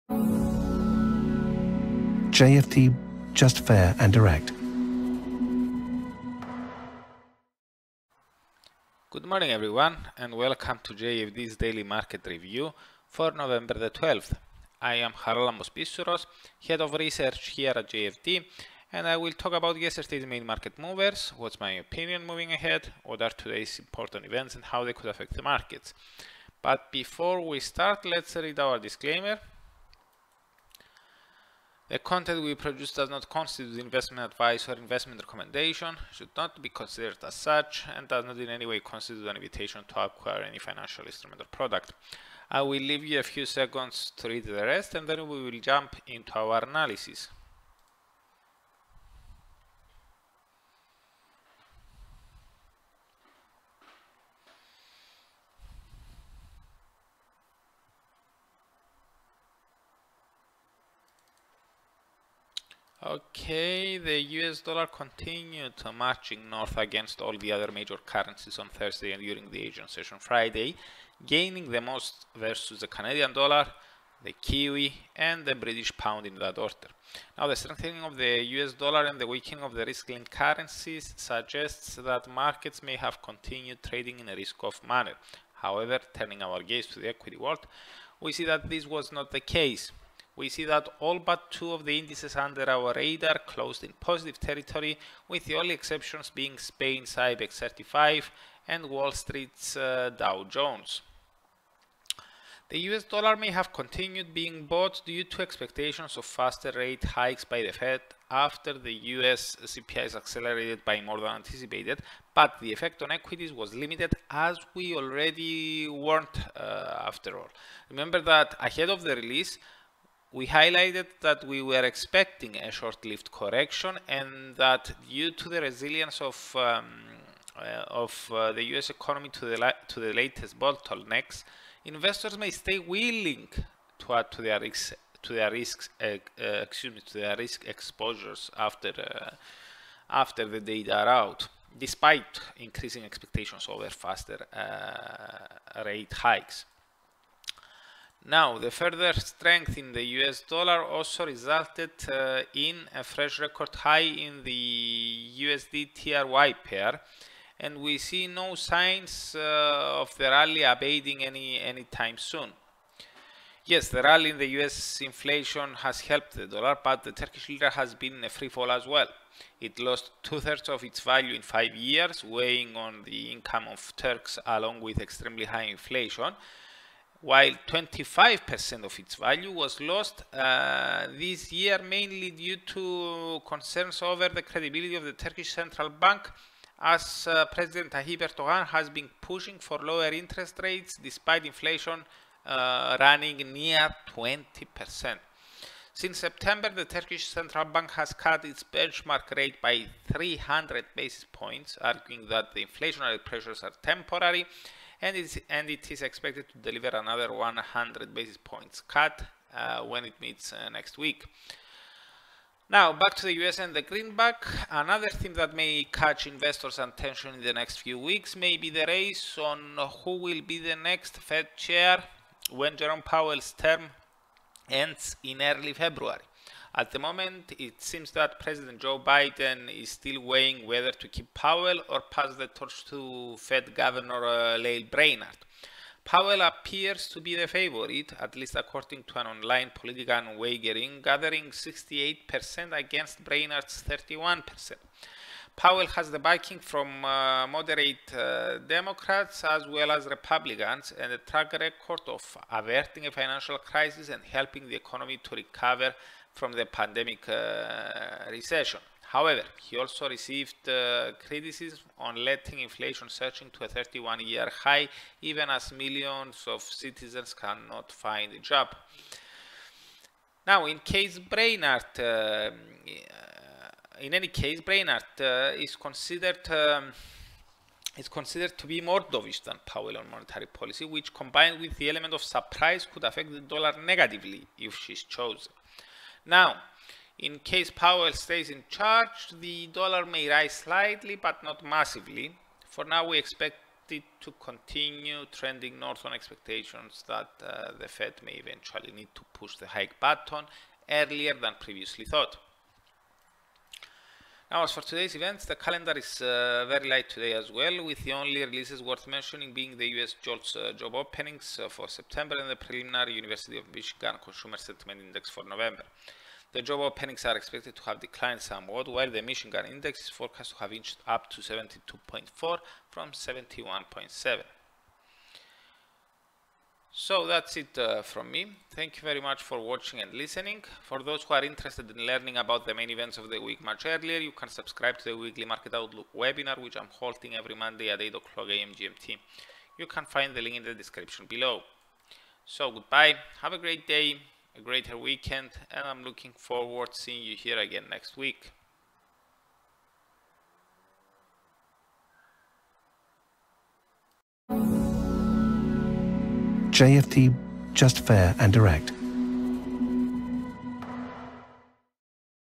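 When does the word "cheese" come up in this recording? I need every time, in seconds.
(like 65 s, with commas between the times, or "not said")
not said.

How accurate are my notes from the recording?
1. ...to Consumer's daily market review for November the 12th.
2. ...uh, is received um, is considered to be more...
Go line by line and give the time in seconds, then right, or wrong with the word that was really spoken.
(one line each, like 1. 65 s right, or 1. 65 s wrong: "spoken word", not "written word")
1. 10 s wrong: "JFD", not "Consumer"
2. 275 s wrong: "considered", not "received".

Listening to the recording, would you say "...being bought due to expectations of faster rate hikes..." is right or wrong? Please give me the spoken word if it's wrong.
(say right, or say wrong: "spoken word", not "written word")
right.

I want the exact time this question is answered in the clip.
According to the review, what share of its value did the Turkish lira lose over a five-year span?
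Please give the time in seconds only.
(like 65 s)
170 s.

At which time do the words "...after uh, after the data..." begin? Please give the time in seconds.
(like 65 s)
138 s.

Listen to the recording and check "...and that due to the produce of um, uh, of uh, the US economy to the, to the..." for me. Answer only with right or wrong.
wrong.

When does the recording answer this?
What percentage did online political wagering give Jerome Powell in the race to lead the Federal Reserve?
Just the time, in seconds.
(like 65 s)
241 s.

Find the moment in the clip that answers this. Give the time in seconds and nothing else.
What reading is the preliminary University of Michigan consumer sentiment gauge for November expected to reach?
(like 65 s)
321 s.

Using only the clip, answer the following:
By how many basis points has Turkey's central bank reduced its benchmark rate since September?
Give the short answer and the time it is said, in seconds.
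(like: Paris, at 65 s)
300, at 200 s.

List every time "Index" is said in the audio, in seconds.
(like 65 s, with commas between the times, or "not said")
314 s, 319 s.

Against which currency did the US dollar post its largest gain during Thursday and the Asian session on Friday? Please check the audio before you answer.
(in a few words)
Canadian dollar.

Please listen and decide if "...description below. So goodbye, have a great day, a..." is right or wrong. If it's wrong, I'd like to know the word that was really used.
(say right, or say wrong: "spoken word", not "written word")
right.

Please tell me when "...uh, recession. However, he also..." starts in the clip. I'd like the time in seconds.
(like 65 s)
257 s.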